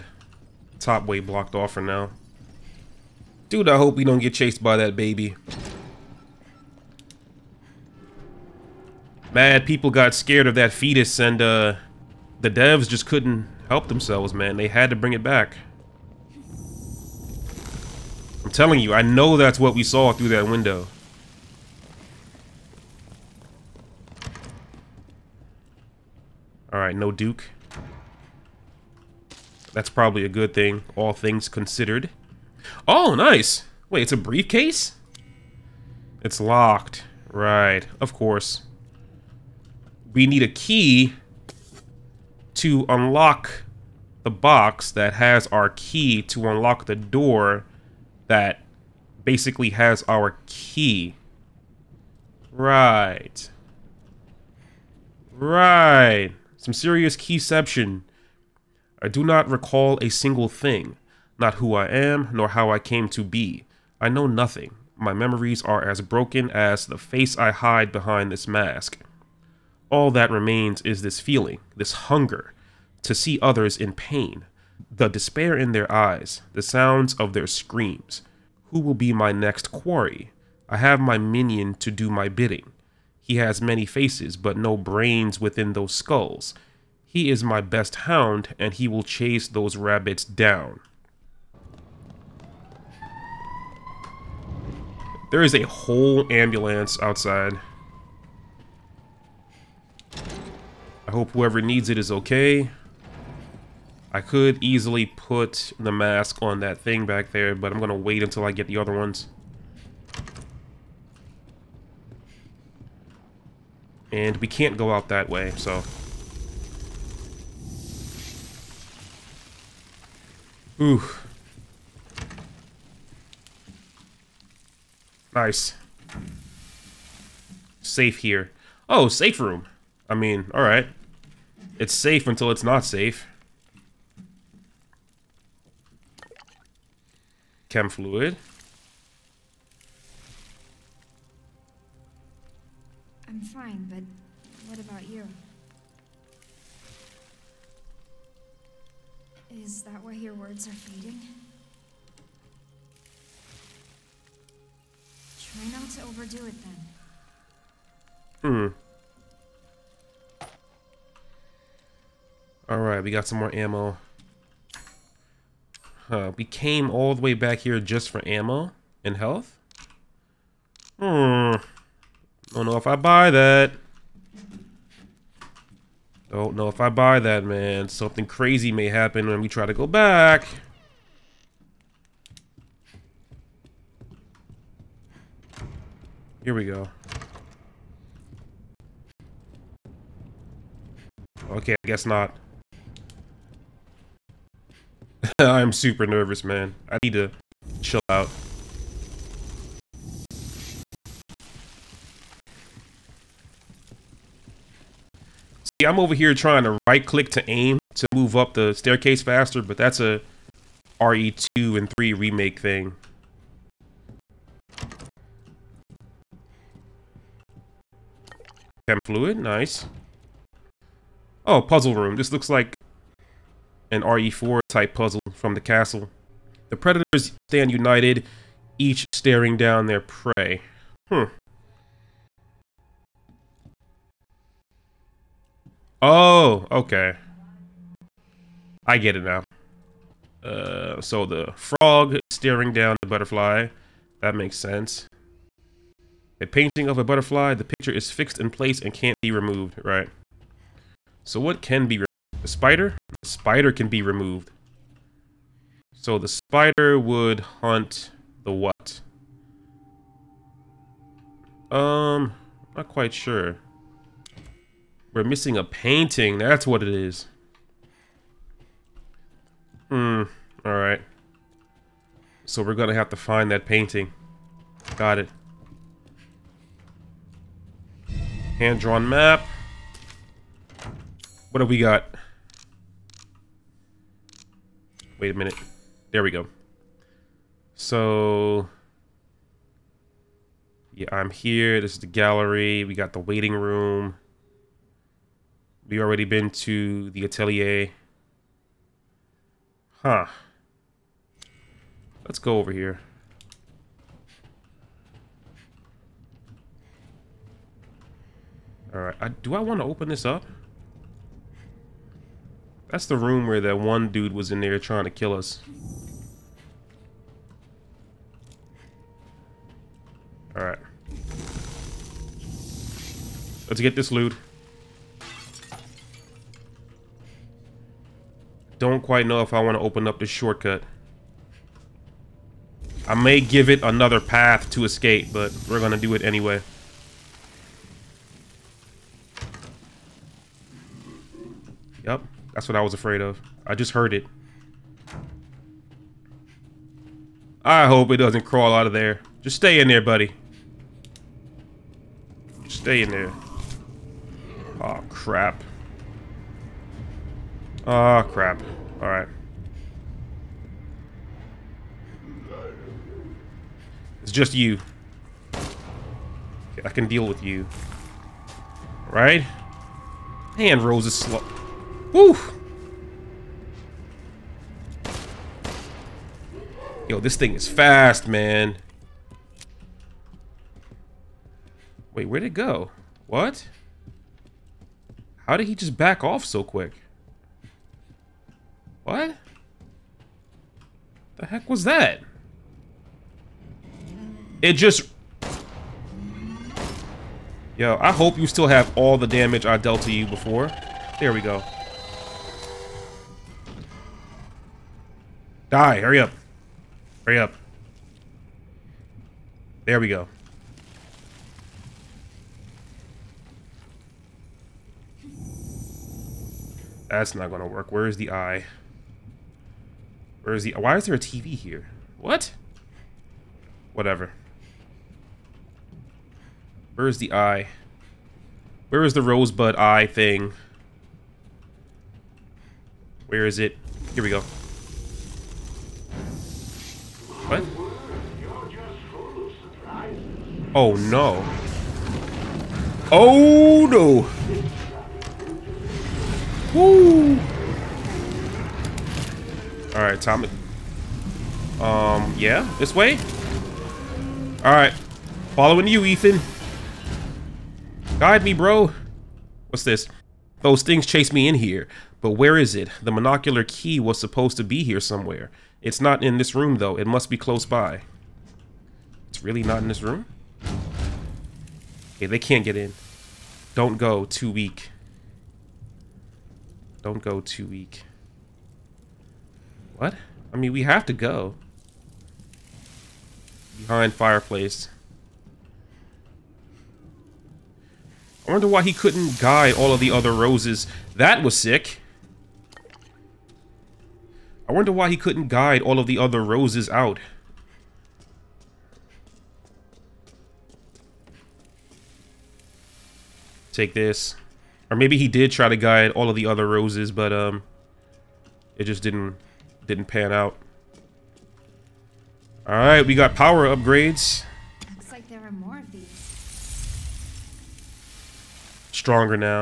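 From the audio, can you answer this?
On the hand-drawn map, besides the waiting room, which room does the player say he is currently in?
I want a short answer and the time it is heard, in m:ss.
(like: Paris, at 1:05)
Gallery, at 4:52.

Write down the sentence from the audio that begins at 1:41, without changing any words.
I hope whoever needs it is okay.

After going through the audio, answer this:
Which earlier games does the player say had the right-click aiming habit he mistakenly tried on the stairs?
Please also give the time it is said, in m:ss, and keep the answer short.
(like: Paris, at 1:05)
RE2 and 3 remake, at 3:31.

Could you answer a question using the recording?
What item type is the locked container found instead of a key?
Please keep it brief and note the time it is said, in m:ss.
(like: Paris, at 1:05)
Briefcase, at 0:34.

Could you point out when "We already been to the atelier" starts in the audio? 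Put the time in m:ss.
4:55.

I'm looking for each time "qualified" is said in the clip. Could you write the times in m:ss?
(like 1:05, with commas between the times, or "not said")
not said.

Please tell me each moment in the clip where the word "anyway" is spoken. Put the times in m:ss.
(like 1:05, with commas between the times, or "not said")
5:36.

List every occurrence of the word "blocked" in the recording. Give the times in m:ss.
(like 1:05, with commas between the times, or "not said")
0:01.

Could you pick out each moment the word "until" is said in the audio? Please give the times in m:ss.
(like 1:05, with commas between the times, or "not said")
1:48, 2:12.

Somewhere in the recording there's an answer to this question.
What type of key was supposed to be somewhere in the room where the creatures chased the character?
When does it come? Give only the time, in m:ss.
7:43.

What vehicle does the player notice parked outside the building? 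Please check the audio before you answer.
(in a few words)
Ambulance.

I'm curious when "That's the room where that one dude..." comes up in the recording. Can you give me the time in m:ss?
5:12.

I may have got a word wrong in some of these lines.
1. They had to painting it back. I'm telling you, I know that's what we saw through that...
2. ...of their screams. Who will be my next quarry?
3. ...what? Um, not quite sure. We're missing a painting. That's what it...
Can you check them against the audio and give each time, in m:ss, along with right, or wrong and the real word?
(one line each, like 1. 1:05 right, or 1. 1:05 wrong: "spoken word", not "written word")
1. 0:14 wrong: "bring", not "painting"
2. 1:17 right
3. 4:18 right.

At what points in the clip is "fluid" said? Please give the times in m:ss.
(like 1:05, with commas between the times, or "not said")
2:17, 3:39.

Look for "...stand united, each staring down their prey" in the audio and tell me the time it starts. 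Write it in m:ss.
3:47.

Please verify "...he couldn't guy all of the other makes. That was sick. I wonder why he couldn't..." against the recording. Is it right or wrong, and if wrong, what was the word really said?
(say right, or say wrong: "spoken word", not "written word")
wrong: "roses", not "makes".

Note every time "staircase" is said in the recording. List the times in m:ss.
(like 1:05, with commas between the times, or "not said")
3:28.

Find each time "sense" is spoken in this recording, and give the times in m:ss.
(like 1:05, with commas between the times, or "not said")
4:04.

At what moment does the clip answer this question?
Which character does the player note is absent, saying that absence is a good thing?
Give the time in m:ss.
0:27.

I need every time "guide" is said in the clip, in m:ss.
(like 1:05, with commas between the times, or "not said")
7:38, 8:15, 8:25.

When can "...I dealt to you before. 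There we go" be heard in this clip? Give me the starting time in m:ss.
6:39.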